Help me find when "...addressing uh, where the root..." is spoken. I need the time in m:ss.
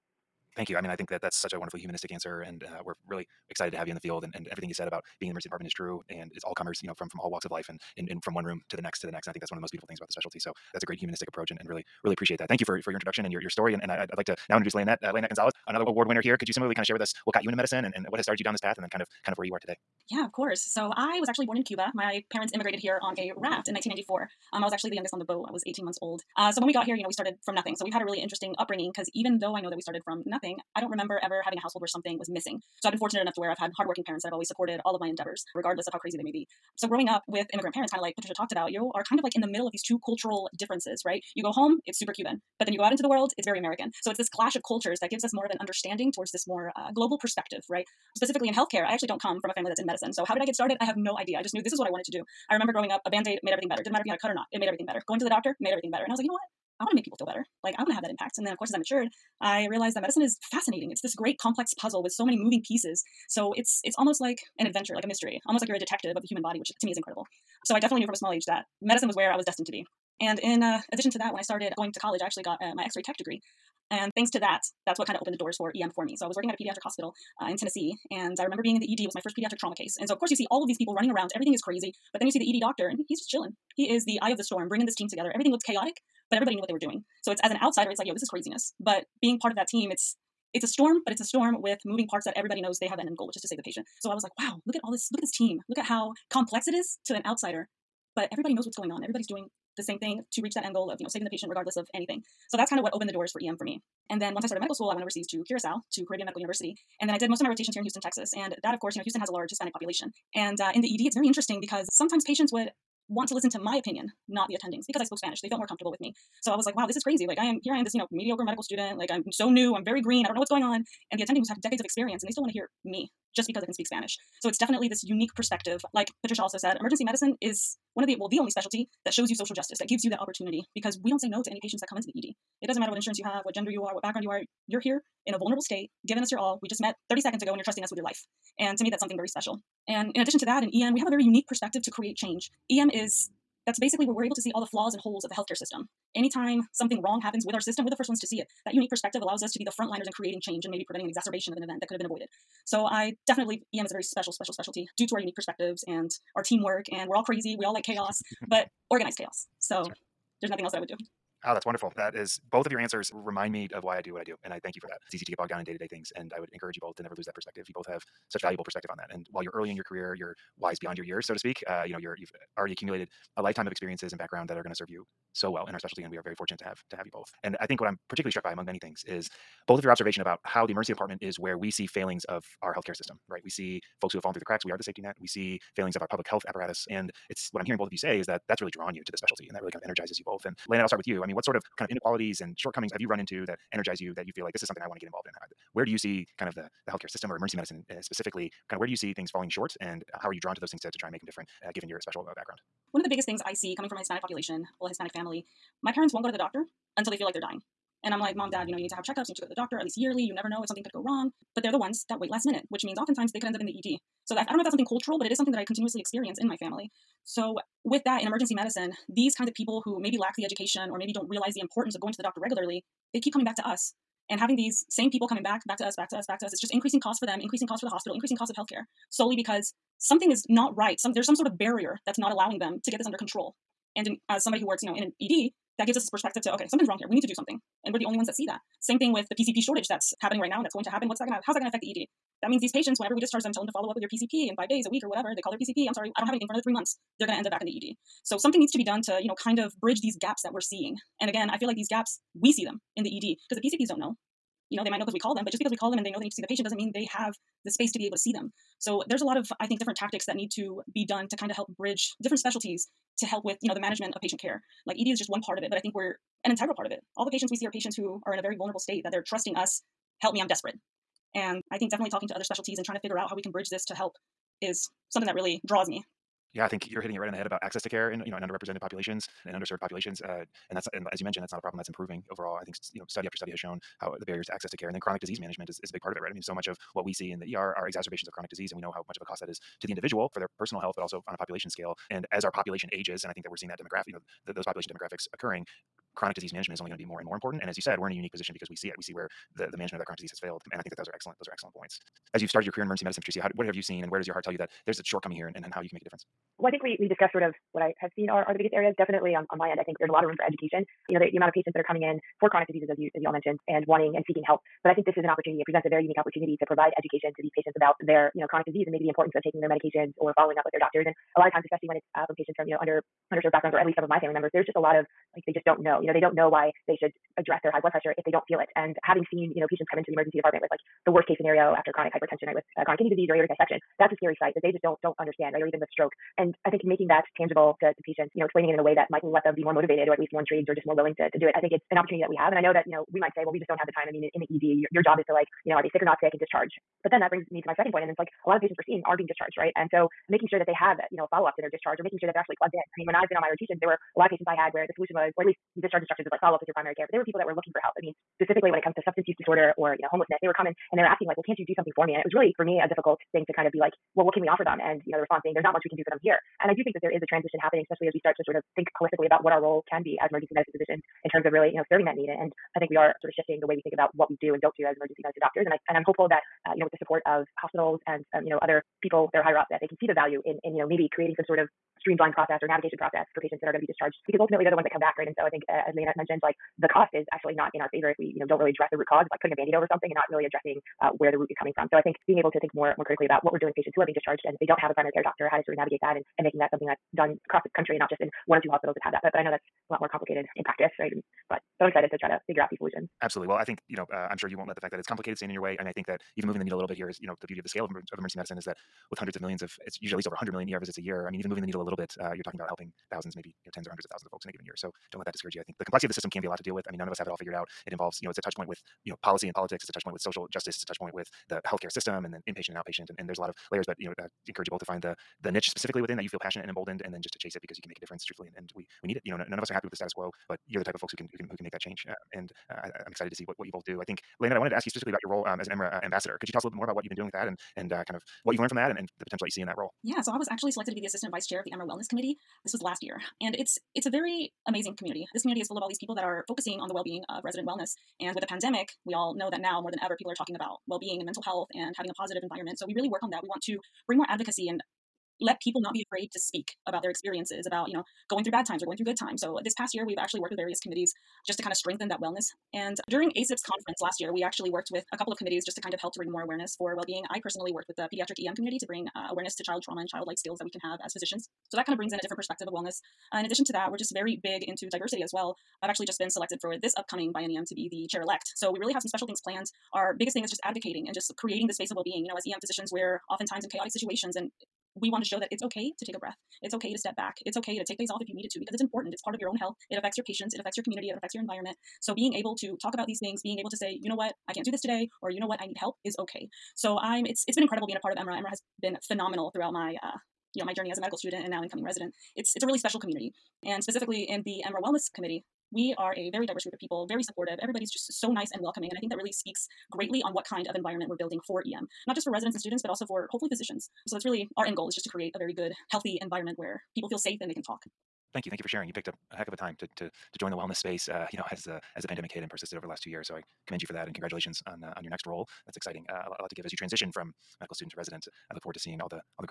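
6:30.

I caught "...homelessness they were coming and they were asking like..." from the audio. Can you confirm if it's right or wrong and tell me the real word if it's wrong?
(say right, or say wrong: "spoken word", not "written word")
right.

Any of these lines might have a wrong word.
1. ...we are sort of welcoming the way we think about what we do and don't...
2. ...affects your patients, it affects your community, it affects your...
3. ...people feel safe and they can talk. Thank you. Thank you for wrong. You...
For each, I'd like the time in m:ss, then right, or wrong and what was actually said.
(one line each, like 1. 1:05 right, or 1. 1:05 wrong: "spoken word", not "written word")
1. 6:12 wrong: "shifting", not "welcoming"
2. 8:09 right
3. 8:36 wrong: "sharing", not "wrong".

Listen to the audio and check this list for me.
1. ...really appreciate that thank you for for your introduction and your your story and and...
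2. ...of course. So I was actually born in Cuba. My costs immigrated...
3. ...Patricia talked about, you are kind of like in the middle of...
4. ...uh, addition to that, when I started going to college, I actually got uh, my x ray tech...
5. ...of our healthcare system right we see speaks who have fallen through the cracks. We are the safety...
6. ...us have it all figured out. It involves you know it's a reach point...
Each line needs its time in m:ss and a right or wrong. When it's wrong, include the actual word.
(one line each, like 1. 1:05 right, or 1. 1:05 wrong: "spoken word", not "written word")
1. 0:12 right
2. 0:20 wrong: "parents", not "costs"
3. 0:38 right
4. 1:10 right
5. 3:02 wrong: "folks", not "speaks"
6. 6:57 wrong: "touch", not "reach".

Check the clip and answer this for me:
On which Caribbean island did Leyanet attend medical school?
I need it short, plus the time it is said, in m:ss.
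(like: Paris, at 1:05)
Curacao, at 1:45.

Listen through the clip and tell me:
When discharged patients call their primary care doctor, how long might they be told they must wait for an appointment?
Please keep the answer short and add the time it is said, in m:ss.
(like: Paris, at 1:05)
3 months, at 4:06.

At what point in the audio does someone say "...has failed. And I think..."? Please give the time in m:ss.
5:00.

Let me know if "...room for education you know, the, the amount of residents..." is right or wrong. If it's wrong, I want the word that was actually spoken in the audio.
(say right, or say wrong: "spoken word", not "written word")
wrong: "patients", not "residents".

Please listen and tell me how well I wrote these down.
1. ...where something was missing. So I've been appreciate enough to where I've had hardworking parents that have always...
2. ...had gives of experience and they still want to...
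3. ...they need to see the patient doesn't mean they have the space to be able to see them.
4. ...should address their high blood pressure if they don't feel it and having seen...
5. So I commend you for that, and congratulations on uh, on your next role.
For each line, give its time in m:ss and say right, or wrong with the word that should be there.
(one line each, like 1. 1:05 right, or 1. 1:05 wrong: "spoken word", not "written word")
1. 0:31 wrong: "fortunate", not "appreciate"
2. 2:01 wrong: "decades", not "gives"
3. 4:16 right
4. 5:27 right
5. 8:43 right.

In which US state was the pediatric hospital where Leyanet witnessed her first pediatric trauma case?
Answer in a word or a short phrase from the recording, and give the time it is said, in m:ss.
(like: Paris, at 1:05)
Tennessee, at 1:17.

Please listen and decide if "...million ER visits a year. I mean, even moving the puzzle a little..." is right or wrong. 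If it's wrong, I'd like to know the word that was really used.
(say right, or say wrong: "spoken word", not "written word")
wrong: "needle", not "puzzle".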